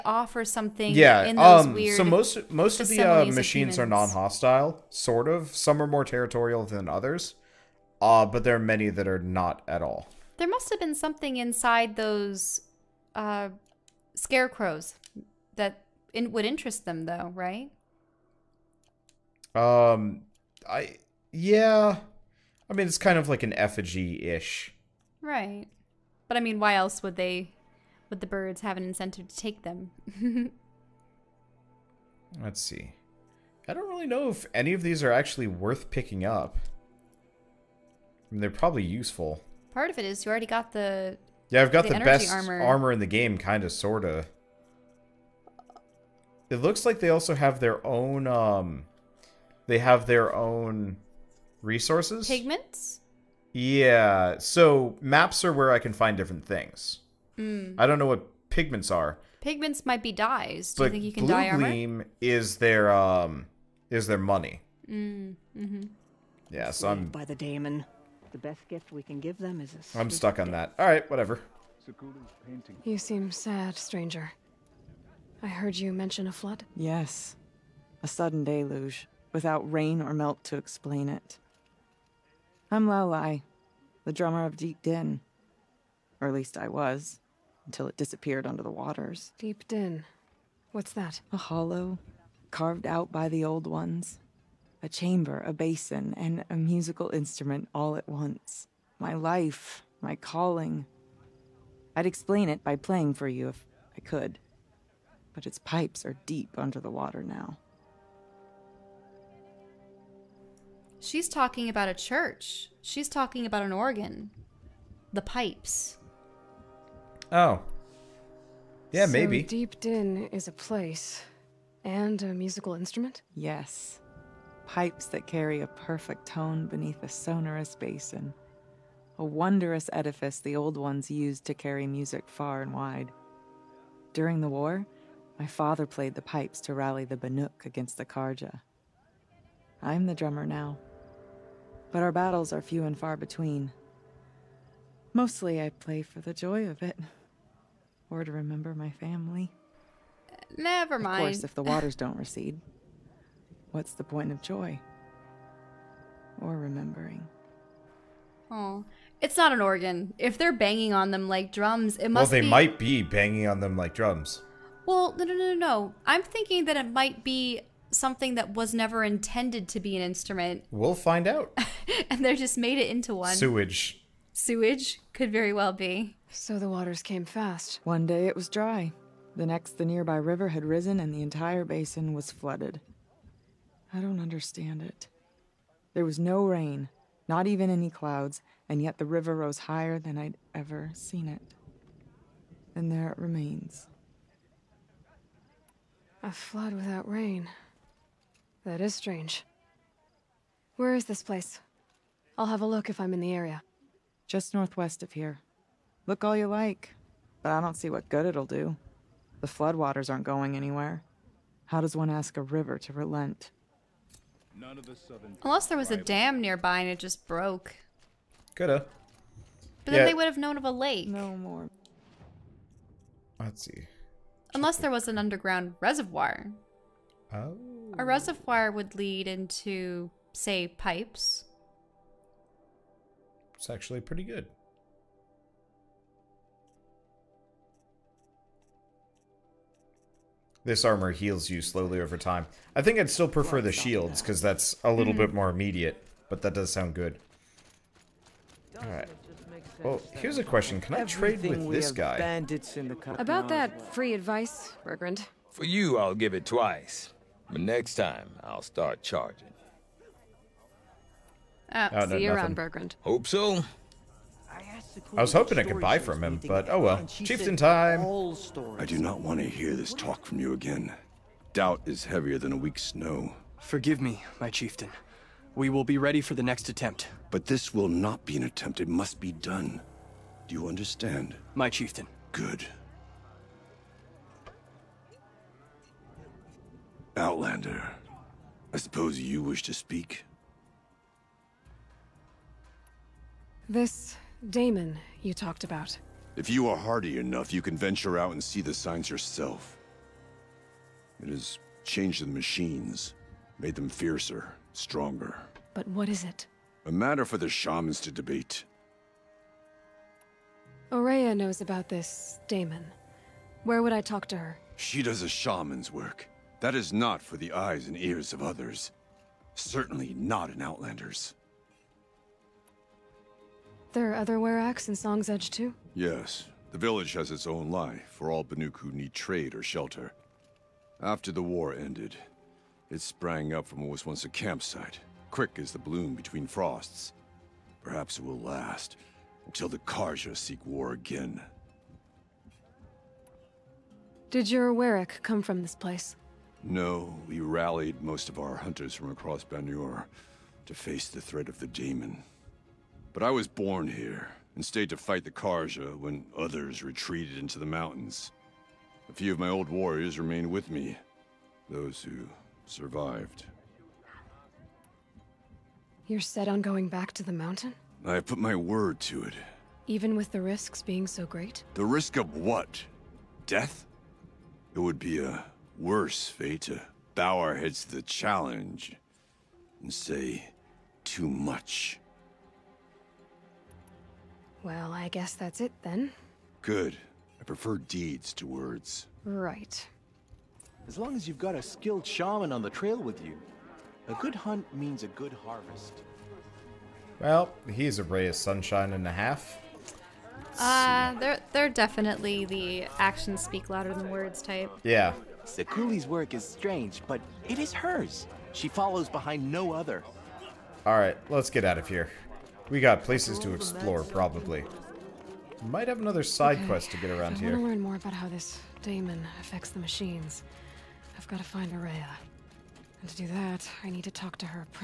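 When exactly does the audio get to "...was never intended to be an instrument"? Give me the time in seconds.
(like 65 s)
168 s.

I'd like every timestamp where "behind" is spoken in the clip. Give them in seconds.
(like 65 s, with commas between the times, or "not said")
409 s.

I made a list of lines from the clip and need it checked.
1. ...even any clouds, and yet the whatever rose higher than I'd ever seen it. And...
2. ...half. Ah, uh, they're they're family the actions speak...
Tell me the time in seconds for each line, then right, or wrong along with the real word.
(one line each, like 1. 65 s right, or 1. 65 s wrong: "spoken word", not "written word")
1. 187 s wrong: "river", not "whatever"
2. 399 s wrong: "definitely", not "family".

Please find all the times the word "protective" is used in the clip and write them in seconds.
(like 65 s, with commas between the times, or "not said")
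not said.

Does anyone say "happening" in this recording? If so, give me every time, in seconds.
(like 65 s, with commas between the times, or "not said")
not said.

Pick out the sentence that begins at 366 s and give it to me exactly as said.
You're set on going back to the mountain?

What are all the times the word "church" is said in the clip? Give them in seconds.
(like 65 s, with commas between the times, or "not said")
111 s.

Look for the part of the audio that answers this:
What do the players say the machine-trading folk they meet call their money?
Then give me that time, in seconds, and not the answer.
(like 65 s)
61 s.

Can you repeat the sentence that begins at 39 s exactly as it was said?
Part of it is you already got the yeah, I've got the, the best armor.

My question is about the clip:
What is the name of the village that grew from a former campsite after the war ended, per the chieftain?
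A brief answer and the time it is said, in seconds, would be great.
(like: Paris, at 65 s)
Song's Edge, at 324 s.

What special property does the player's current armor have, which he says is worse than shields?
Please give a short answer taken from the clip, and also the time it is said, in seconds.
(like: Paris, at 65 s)
Heals you slowly over time, at 241 s.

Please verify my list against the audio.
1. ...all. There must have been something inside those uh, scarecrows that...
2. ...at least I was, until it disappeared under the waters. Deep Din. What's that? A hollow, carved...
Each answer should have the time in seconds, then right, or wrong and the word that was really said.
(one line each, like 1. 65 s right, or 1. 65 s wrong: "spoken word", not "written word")
1. 9 s right
2. 86 s right.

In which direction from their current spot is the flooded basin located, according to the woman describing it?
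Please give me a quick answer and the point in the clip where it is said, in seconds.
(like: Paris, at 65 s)
Northwest, at 204 s.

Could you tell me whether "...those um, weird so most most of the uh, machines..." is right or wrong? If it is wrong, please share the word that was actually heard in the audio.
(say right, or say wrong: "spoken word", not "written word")
right.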